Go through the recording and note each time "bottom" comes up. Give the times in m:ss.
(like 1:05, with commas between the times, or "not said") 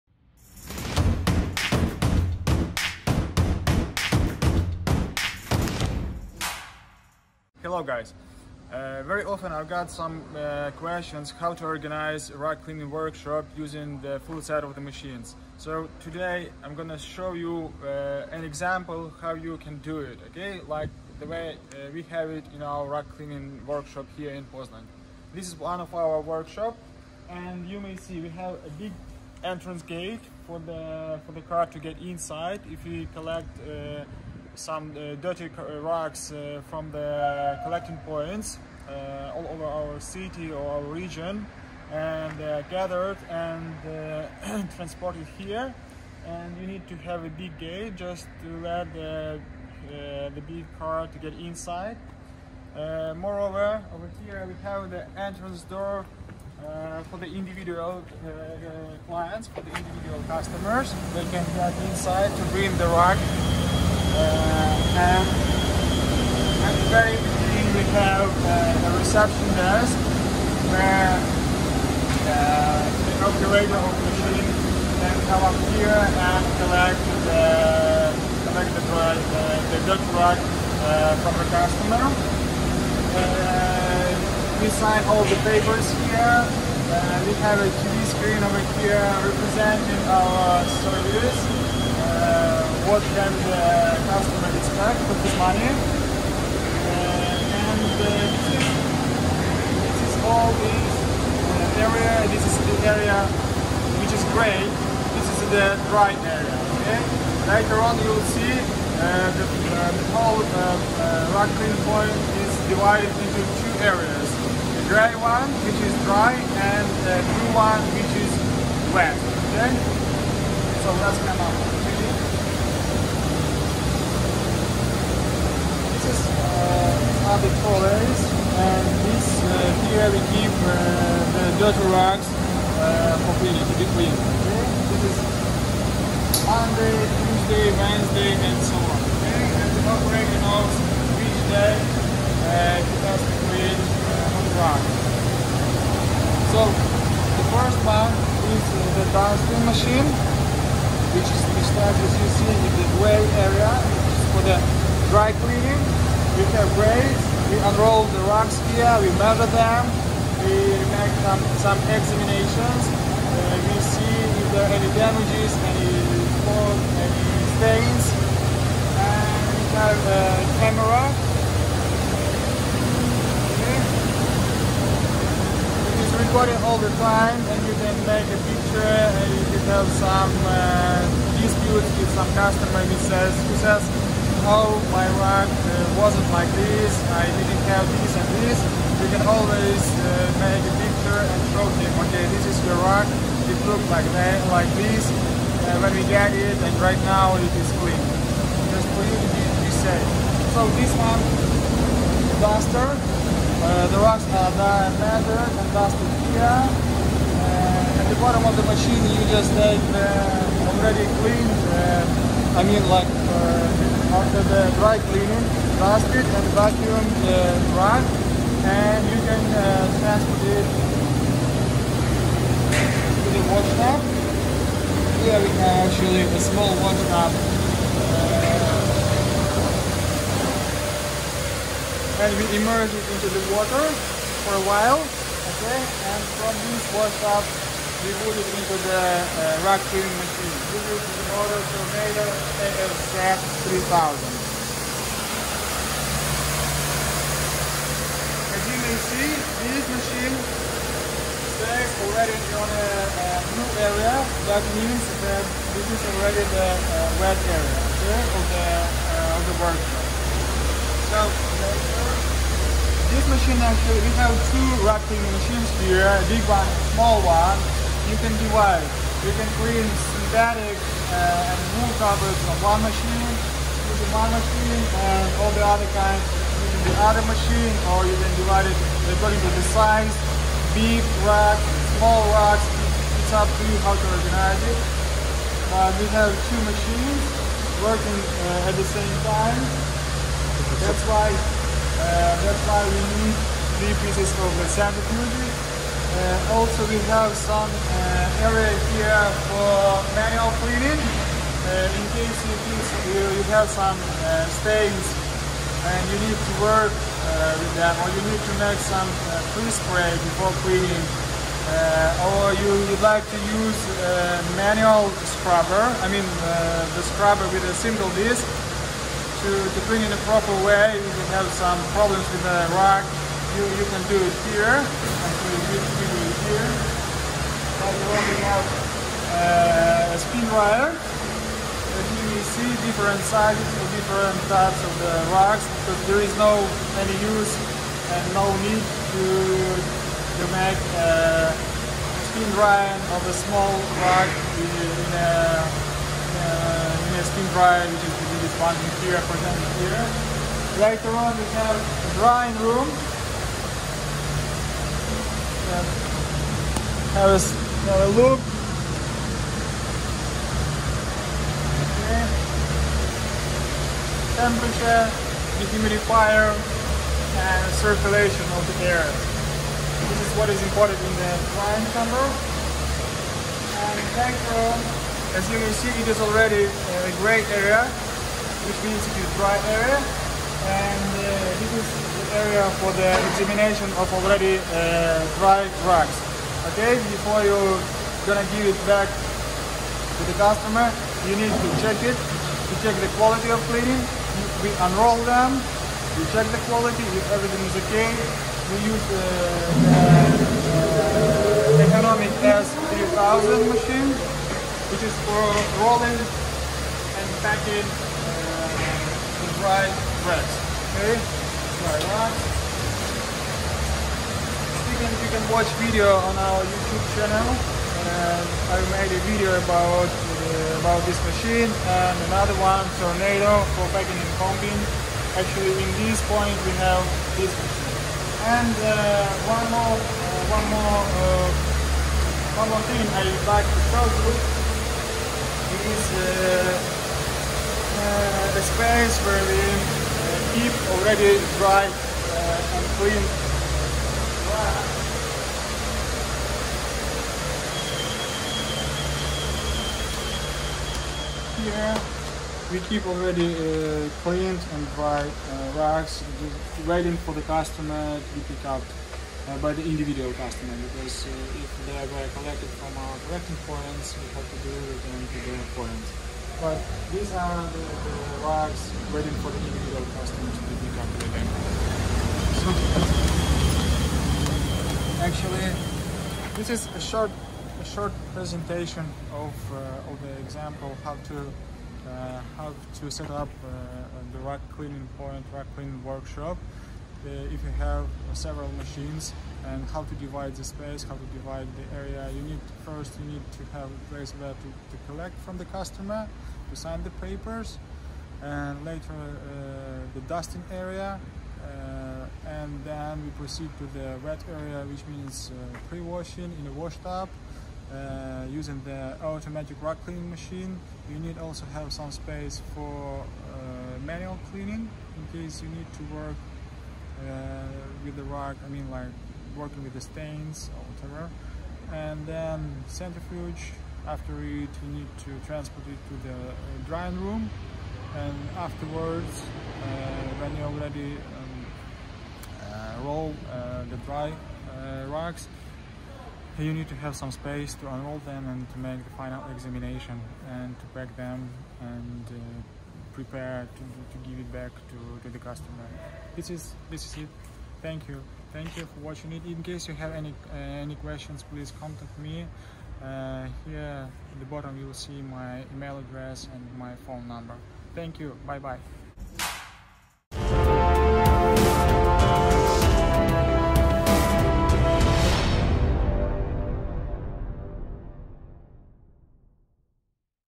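3:28, 9:14.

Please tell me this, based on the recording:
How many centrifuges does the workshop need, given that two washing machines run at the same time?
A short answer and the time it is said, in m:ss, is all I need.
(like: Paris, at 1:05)
3, at 4:53.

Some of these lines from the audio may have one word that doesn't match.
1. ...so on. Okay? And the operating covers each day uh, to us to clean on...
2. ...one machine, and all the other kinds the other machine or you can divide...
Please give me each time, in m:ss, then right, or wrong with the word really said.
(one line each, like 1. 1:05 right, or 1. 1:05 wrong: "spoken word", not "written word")
1. 2:18 wrong: "hours", not "covers"
2. 4:34 right.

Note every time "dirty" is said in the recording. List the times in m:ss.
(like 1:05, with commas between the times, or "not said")
0:35, 2:11.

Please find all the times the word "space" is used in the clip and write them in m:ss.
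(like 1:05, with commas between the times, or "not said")
7:18, 8:10, 8:32, 8:57.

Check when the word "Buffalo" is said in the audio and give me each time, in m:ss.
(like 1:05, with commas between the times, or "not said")
not said.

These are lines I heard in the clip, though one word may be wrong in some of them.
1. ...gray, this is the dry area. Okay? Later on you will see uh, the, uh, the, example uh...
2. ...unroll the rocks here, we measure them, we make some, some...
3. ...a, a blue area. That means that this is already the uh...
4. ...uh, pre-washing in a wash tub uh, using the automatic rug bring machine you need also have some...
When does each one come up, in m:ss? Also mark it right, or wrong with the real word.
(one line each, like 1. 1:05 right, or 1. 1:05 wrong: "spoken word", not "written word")
1. 1:44 wrong: "whole", not "example"
2. 2:37 right
3. 4:12 right
4. 8:25 wrong: "cleaning", not "bring".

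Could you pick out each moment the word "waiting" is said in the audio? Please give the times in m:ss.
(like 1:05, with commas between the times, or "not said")
7:36, 7:49.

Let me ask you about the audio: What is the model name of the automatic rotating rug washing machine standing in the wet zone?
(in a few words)
Tornado ASF 3000.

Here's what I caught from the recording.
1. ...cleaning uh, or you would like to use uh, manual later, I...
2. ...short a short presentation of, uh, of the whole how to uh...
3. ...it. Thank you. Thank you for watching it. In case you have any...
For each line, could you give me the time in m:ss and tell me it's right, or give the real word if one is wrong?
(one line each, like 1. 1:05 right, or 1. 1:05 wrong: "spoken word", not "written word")
1. 5:10 wrong: "scrubber", not "later"
2. 7:57 wrong: "example", not "whole"
3. 9:07 right.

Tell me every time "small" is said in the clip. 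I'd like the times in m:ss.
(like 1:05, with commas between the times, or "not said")
3:46, 4:26, 4:41, 5:43.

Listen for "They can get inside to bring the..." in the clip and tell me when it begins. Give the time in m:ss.
1:01.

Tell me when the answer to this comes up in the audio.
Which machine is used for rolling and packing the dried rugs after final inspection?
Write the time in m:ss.
6:41.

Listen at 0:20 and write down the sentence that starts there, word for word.
Like the way uh, we have it in our rug cleaning workshop here in Poznan.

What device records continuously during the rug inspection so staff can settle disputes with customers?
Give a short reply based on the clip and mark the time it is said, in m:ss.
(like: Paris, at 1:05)
A camera, at 2:50.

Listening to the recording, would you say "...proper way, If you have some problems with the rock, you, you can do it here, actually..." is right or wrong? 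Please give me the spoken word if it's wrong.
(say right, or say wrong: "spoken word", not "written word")
right.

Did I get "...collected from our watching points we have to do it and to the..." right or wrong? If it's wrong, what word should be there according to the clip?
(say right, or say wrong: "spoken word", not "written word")
wrong: "collecting", not "watching".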